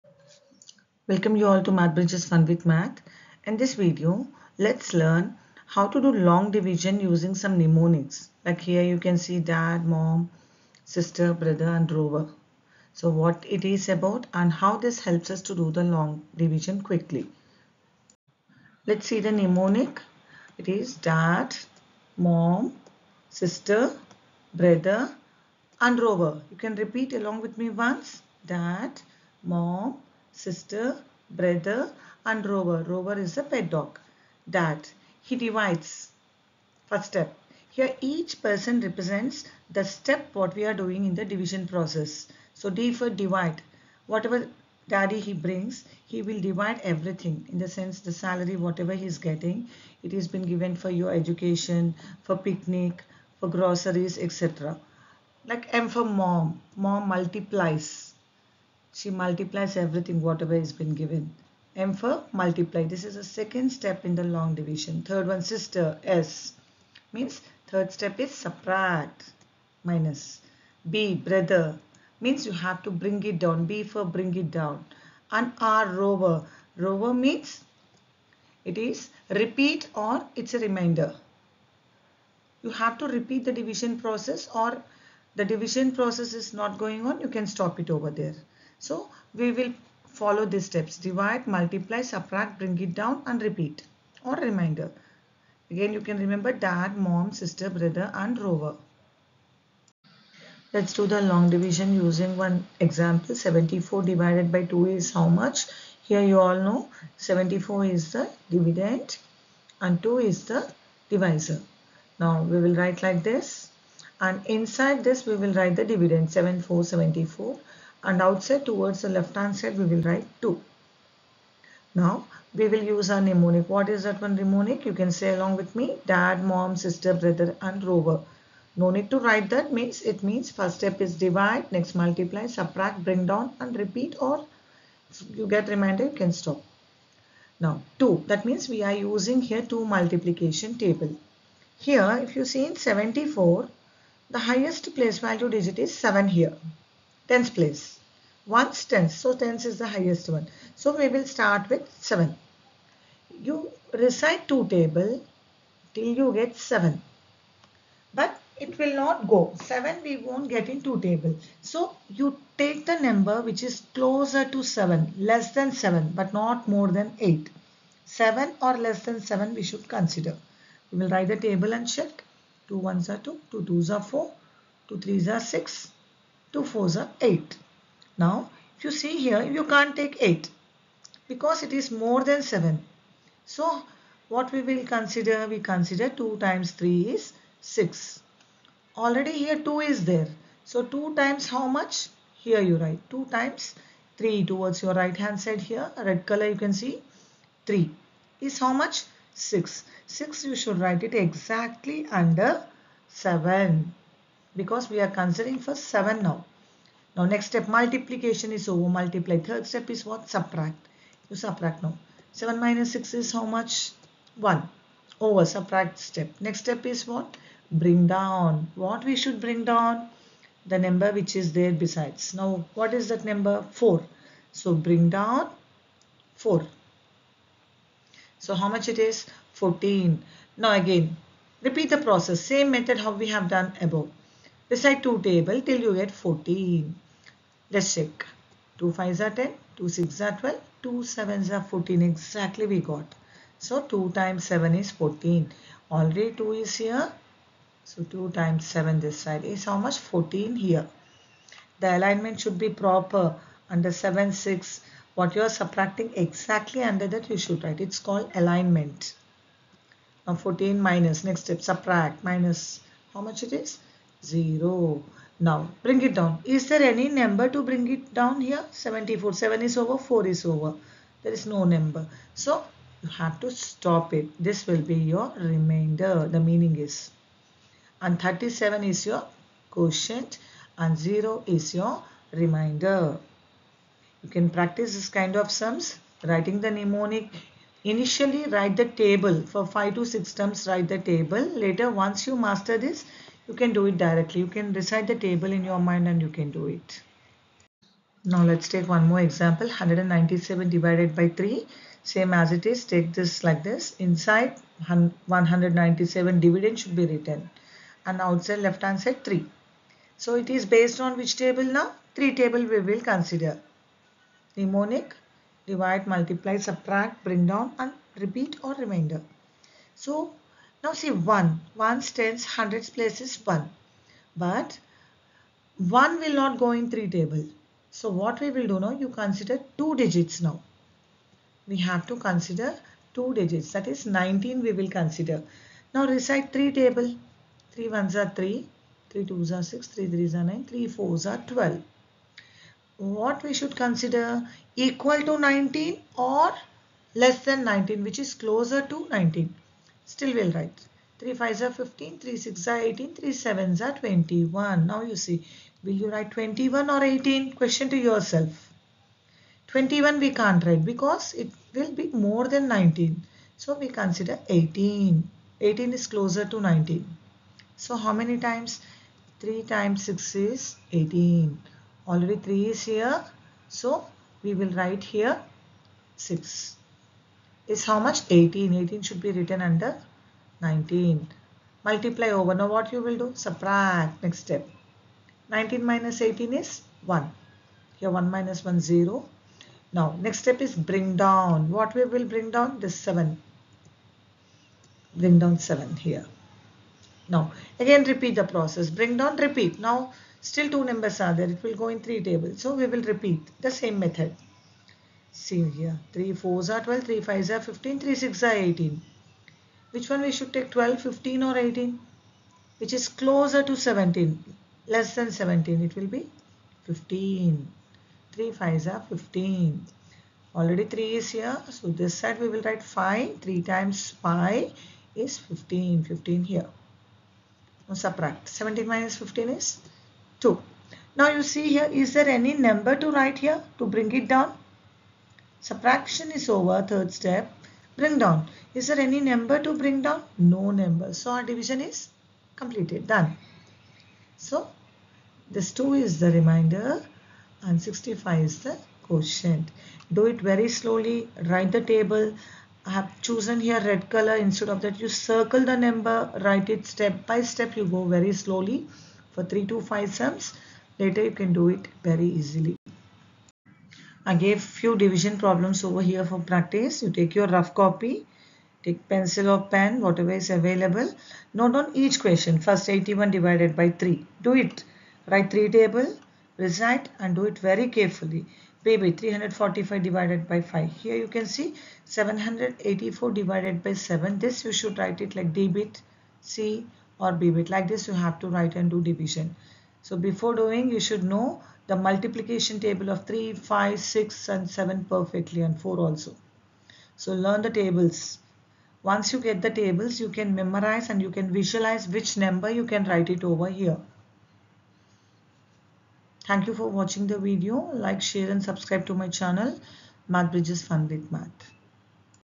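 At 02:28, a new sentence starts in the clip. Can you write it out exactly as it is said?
Once tenth, so tens is the highest one.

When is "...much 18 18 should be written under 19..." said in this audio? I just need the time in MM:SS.
06:18.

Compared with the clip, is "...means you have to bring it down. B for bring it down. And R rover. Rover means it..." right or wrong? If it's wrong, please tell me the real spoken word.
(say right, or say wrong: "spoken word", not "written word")
right.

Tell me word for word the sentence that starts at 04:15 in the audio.
What you are subtracting exactly under that you should write.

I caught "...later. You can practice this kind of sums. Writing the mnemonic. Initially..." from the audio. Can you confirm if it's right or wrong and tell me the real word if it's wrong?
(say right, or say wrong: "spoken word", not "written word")
wrong: "remainder", not "later".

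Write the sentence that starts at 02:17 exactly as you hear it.
Now 2 that means we are using here 2 multiplication table.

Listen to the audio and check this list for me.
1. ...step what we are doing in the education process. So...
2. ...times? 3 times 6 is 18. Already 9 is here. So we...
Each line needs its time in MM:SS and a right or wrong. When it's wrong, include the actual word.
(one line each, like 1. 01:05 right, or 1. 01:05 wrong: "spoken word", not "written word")
1. 00:39 wrong: "division", not "education"
2. 06:08 wrong: "3", not "9".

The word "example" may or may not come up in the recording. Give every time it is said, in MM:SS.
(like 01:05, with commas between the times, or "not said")
01:42, 04:59.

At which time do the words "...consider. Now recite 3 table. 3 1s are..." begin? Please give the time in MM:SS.
05:34.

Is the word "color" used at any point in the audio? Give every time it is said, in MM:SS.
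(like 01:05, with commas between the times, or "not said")
03:16, 07:34.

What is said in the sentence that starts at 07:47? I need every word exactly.
You take your rough copy, take pencil or pen, whatever is available.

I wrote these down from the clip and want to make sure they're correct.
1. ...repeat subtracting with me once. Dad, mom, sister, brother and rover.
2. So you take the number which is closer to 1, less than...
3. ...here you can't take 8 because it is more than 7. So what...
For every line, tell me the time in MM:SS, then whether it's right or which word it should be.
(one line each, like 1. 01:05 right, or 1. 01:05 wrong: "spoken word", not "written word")
1. 00:26 wrong: "along", not "subtracting"
2. 02:41 wrong: "7", not "1"
3. 02:59 right.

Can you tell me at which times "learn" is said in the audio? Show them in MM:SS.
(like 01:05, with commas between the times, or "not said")
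00:04, 08:17.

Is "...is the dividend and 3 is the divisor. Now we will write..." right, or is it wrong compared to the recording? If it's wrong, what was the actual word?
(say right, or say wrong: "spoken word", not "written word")
wrong: "2", not "3".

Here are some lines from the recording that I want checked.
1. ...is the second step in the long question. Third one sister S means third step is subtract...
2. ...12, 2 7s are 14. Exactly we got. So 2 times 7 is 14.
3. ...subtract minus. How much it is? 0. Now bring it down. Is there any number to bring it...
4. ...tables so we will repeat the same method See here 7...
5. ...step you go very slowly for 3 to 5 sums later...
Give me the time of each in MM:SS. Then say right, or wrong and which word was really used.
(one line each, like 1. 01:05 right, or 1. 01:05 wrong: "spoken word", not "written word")
1. 01:03 wrong: "division", not "question"
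2. 04:00 right
3. 04:21 right
4. 06:42 wrong: "3", not "7"
5. 07:37 right.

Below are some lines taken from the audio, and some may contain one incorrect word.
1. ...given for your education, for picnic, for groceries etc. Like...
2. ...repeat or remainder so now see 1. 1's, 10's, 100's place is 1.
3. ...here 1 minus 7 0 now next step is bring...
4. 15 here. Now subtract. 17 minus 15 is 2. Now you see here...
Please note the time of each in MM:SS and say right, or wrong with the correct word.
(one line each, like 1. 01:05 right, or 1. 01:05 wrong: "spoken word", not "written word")
1. 00:50 right
2. 05:18 right
3. 06:28 wrong: "1", not "7"
4. 07:06 right.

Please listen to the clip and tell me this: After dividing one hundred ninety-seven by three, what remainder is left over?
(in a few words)
2.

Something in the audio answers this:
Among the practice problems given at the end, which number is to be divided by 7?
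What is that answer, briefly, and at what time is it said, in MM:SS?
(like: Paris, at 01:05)
784, at 08:02.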